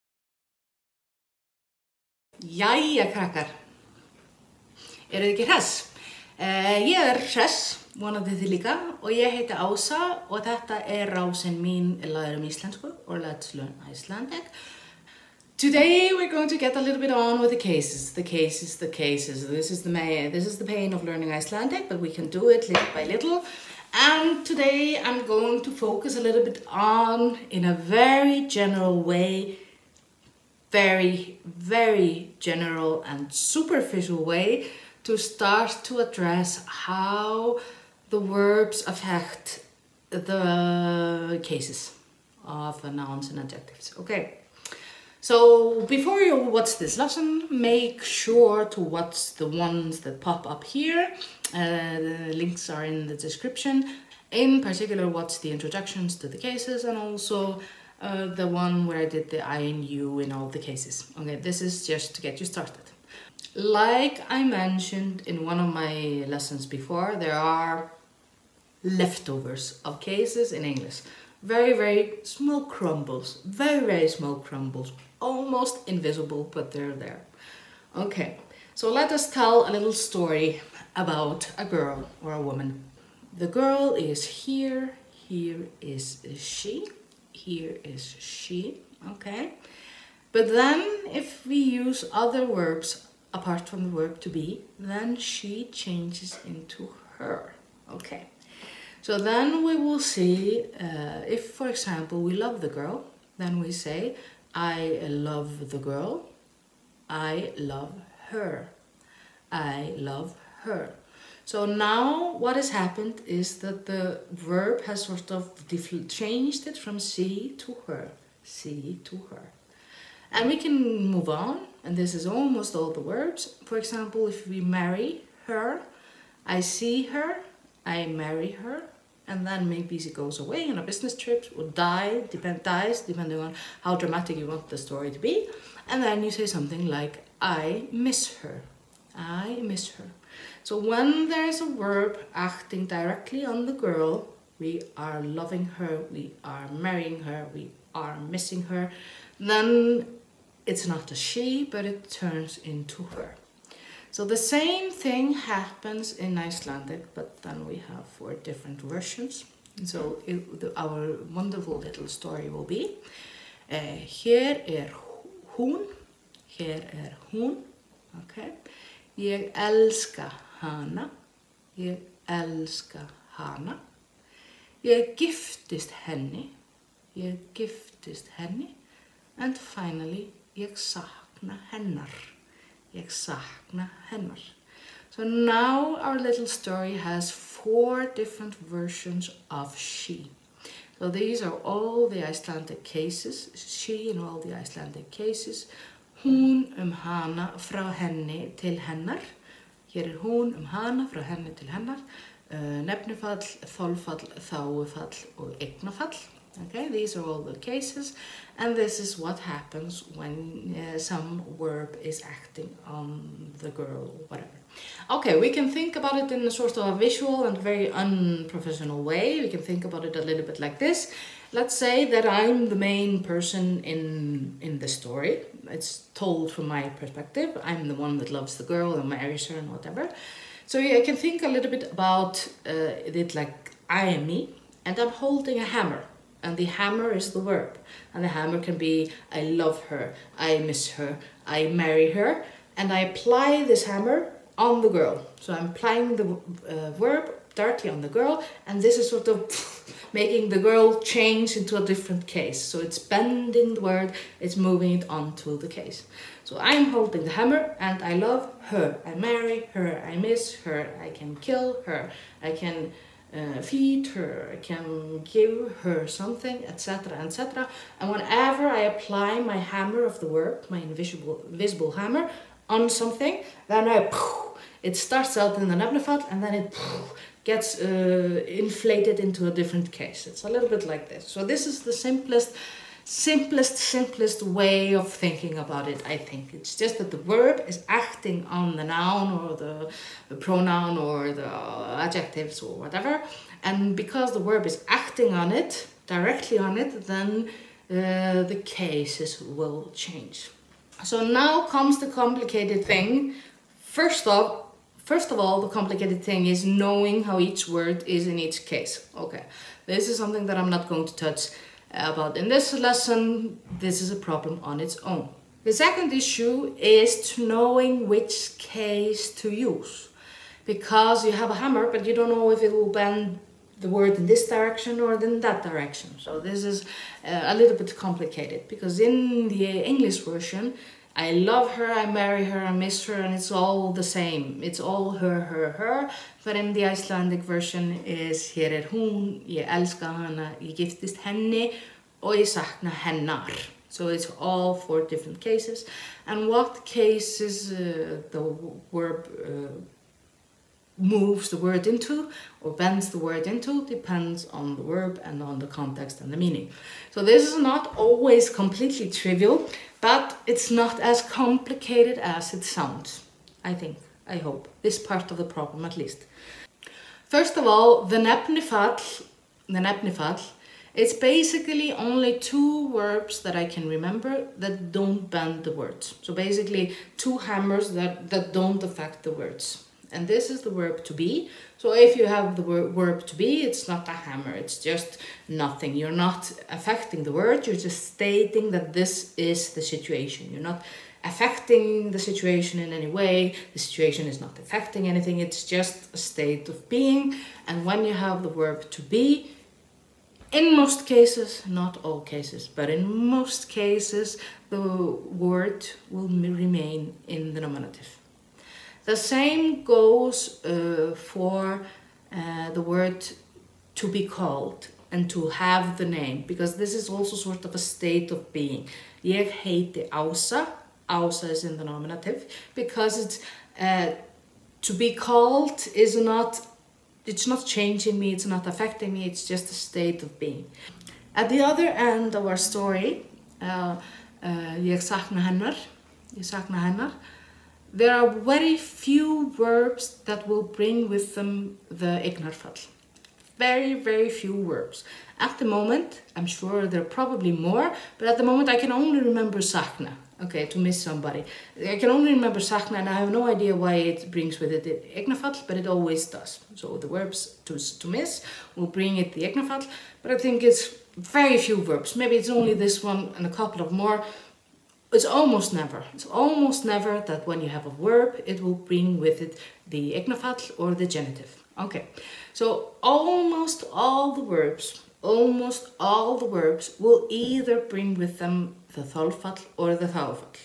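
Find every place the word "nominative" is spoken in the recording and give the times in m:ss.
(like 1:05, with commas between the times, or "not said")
6:47, 7:01.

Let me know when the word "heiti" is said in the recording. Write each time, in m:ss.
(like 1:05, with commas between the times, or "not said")
0:09, 6:59.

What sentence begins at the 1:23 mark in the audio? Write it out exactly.
The girl is here, here is she here is she, okay?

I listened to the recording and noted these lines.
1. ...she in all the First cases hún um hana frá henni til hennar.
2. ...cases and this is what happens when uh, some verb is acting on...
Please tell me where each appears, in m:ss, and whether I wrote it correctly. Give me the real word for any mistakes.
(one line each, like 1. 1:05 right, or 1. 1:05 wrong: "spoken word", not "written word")
1. 3:13 wrong: "Icelandic", not "First"
2. 3:27 right.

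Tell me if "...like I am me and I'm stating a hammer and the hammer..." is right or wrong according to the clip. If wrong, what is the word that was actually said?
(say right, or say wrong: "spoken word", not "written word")
wrong: "holding", not "stating".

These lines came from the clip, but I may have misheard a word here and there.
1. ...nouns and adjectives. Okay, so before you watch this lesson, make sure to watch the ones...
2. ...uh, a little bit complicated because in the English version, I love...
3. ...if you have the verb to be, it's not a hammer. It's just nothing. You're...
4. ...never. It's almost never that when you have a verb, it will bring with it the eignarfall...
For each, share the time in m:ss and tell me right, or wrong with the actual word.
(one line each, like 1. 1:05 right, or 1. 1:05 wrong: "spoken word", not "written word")
1. 0:42 right
2. 5:27 right
3. 6:21 right
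4. 7:45 right.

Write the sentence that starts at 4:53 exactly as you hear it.
And because the verb is acting on it, directly on it, then uh, the cases will change.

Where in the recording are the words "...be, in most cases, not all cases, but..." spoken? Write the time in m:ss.
6:39.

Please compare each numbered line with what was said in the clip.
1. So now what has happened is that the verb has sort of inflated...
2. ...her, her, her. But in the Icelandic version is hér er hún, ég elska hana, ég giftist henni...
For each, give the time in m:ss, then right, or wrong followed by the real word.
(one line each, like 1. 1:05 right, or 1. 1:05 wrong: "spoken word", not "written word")
1. 1:51 wrong: "changed", not "inflated"
2. 5:35 right.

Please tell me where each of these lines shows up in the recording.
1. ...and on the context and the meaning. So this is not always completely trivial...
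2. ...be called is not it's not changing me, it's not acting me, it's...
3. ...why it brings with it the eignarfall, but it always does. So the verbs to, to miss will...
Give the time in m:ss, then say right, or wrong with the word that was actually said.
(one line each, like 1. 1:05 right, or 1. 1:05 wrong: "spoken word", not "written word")
1. 5:55 right
2. 7:04 wrong: "affecting", not "acting"
3. 7:33 right.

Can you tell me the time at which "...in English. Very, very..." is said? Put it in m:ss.
1:10.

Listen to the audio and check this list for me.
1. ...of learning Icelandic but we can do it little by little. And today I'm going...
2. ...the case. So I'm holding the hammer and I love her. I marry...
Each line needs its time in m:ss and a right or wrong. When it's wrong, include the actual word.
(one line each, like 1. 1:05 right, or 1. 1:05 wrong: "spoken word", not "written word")
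1. 0:20 right
2. 4:15 right.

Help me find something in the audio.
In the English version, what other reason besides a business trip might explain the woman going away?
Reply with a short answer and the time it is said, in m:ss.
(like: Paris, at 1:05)
dies, at 2:12.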